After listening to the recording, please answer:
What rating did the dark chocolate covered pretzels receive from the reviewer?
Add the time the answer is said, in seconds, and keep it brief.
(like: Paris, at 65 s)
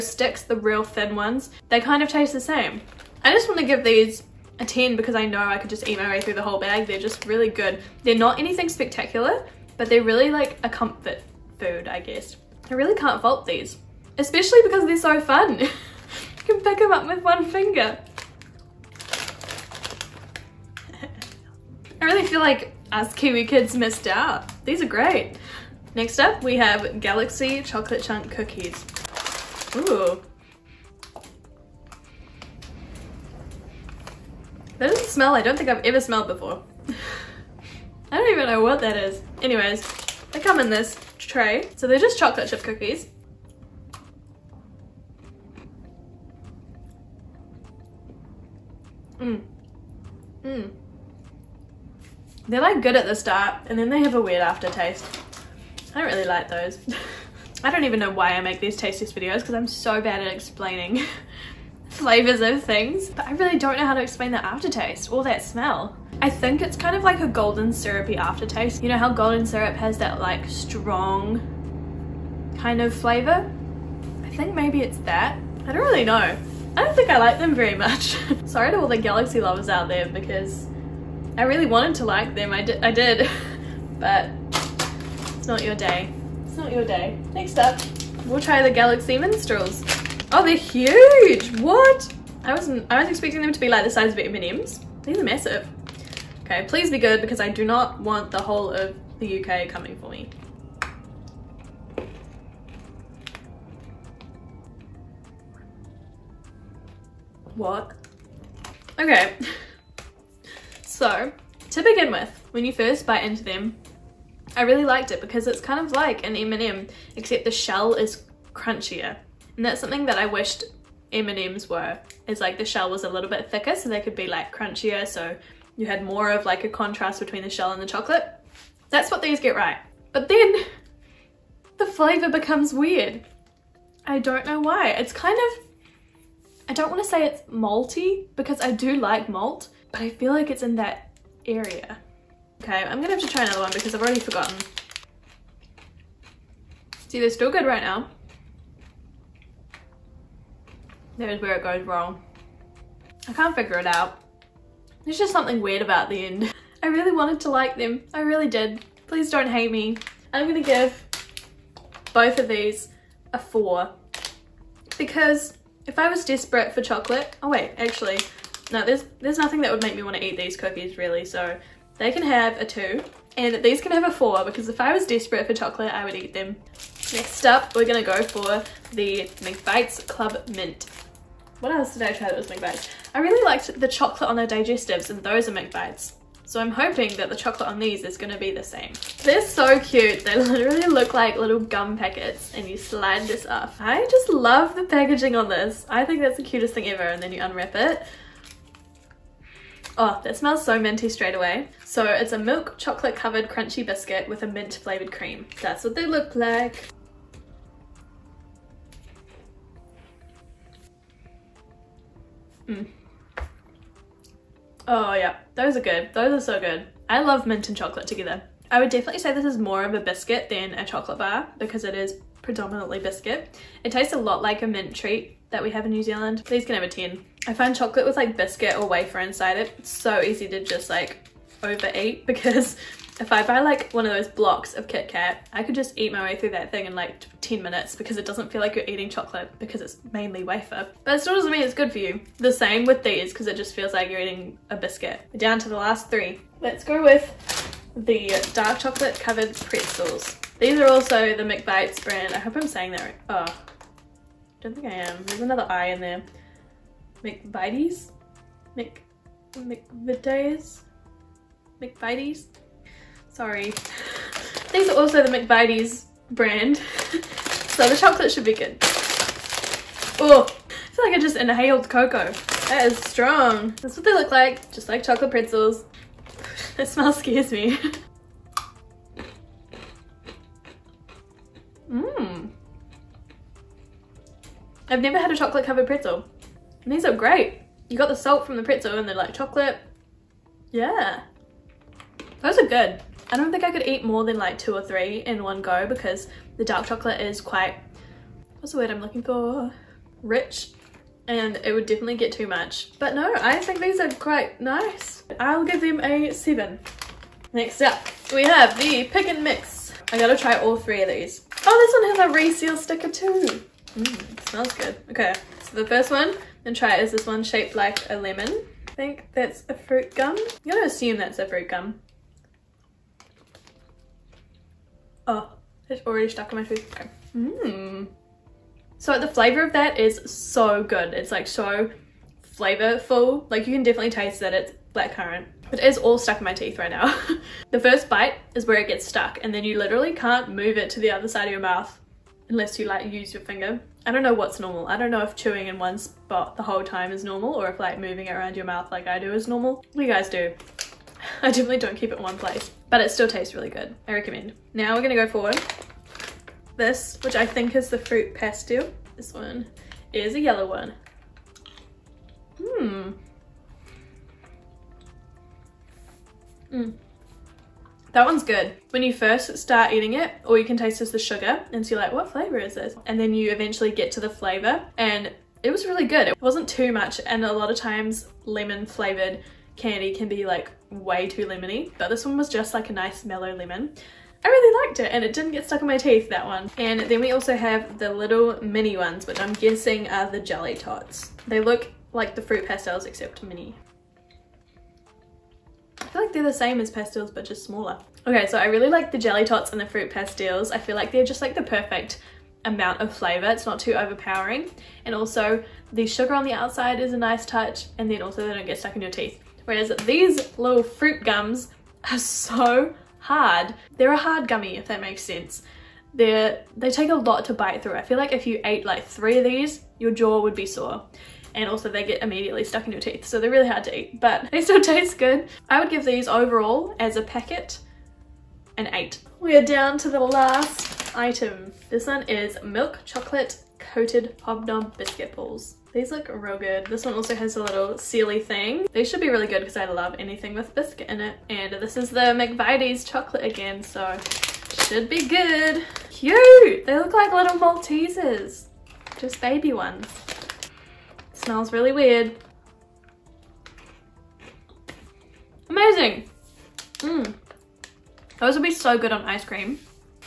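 7, at 305 s.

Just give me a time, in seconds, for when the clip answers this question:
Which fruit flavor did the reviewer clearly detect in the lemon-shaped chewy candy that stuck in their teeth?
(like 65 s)
334 s.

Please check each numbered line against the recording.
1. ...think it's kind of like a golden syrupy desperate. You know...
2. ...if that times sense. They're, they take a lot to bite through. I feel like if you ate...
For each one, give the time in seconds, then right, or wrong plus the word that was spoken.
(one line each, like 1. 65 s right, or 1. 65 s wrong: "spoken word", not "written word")
1. 66 s wrong: "aftertaste", not "desperate"
2. 414 s wrong: "makes", not "times".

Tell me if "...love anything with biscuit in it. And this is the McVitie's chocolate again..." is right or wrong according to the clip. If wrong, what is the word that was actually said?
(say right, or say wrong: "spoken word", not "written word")
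right.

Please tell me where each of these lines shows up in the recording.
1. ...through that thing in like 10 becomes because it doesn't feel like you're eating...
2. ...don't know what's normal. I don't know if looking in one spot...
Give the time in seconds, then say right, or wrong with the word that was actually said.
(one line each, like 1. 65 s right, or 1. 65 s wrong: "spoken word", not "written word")
1. 236 s wrong: "minutes", not "becomes"
2. 344 s wrong: "chewing", not "looking".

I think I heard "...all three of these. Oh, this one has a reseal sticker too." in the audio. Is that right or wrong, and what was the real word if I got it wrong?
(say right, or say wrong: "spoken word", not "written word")
right.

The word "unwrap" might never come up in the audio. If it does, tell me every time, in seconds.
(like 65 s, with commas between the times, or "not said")
197 s.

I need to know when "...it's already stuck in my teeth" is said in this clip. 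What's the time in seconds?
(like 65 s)
325 s.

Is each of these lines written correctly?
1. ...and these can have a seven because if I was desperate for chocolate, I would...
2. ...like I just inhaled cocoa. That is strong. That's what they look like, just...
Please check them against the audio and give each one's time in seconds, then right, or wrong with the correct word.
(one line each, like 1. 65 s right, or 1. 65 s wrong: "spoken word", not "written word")
1. 173 s wrong: "four", not "seven"
2. 271 s right.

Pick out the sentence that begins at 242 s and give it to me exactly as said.
The same with these because it just feels like you're eating a biscuit.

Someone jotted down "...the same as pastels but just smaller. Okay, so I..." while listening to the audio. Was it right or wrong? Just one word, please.
right.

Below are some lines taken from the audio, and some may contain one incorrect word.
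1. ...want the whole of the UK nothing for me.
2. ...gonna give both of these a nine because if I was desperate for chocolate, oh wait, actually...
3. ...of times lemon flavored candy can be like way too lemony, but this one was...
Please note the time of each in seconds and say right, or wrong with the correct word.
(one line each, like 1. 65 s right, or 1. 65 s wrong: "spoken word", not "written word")
1. 97 s wrong: "coming", not "nothing"
2. 160 s wrong: "four", not "nine"
3. 377 s right.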